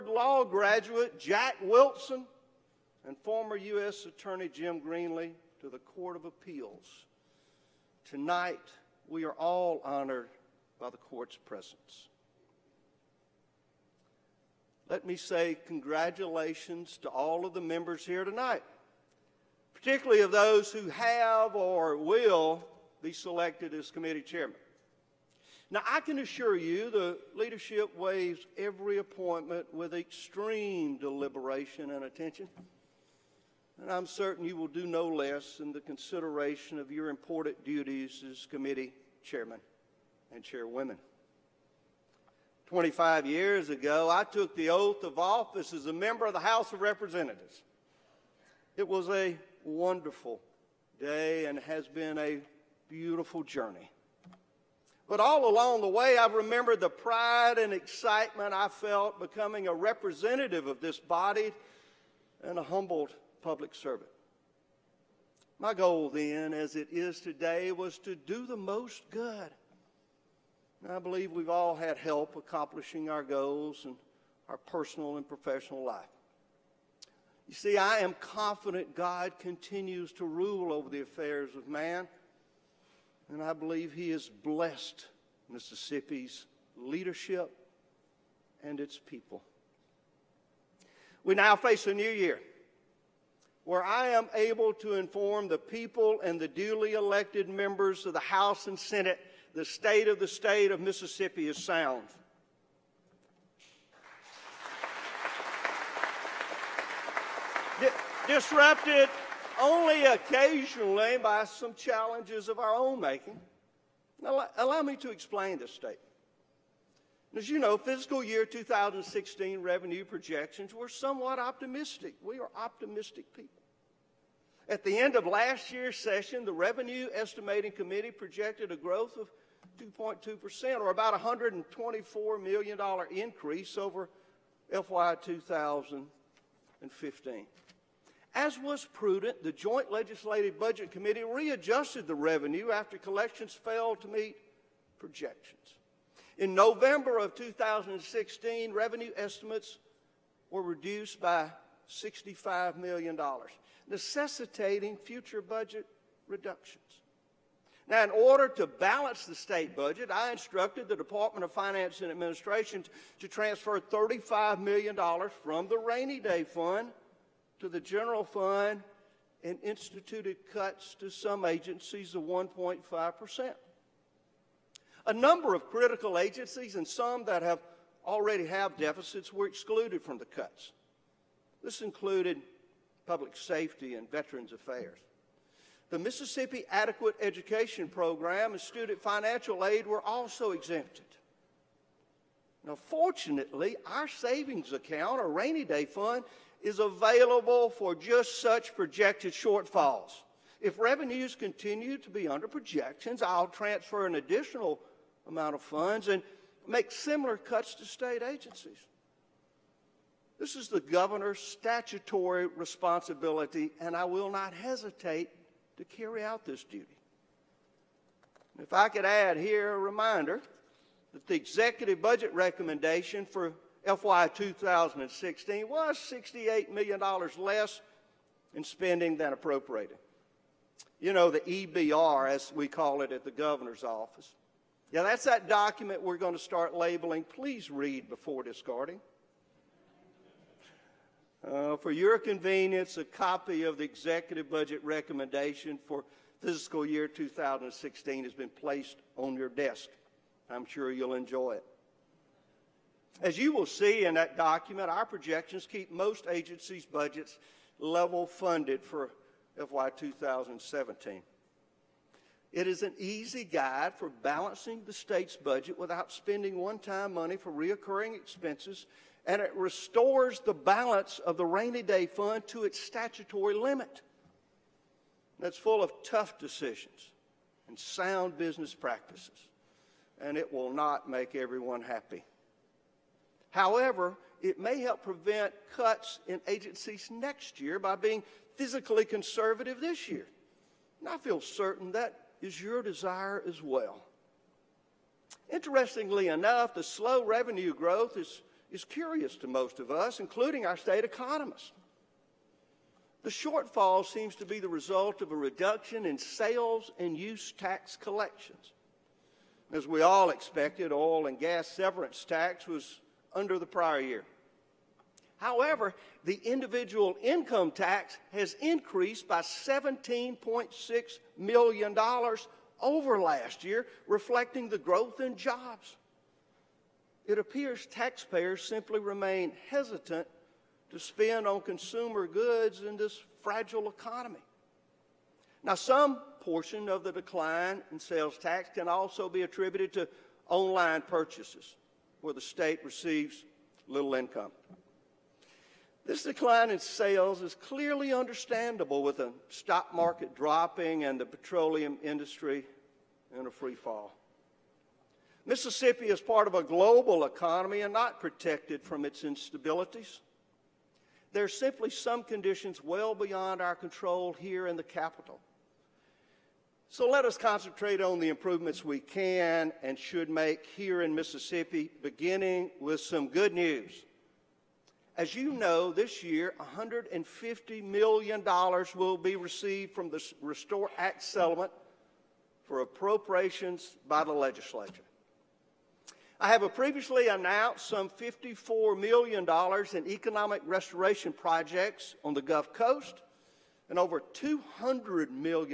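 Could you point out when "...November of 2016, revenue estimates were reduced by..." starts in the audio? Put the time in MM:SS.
02:26.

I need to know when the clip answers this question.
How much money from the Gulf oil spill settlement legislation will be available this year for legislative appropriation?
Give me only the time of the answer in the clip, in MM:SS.
06:16.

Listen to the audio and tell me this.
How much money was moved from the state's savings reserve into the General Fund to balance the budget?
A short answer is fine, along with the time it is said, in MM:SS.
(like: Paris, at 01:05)
$35 million, at 02:43.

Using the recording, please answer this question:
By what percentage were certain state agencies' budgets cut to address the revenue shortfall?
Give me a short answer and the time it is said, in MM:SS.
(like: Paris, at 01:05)
1.5%, at 02:52.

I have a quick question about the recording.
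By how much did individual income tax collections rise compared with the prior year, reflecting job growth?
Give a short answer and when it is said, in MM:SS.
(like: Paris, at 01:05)
$17.6 million, at 05:19.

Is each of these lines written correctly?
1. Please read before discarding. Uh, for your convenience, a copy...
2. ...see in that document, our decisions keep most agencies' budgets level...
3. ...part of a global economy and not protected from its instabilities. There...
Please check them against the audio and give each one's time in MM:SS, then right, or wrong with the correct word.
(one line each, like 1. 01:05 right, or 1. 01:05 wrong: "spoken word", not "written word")
1. 03:57 right
2. 04:13 wrong: "projections", not "decisions"
3. 05:56 right.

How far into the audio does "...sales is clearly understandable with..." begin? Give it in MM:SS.
05:46.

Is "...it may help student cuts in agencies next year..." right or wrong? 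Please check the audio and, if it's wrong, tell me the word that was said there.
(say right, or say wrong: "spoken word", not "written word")
wrong: "prevent", not "student".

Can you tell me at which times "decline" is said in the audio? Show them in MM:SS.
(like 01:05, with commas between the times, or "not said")
05:37, 05:46.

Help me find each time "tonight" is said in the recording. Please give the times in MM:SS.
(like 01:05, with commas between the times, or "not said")
00:08, 00:18.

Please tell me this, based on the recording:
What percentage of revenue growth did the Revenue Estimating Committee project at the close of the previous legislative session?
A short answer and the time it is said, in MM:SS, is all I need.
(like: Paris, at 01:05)
2.2%, at 02:09.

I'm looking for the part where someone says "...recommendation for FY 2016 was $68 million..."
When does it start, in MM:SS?
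03:42.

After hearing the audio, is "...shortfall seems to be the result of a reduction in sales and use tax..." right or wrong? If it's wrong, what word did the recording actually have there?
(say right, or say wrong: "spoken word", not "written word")
right.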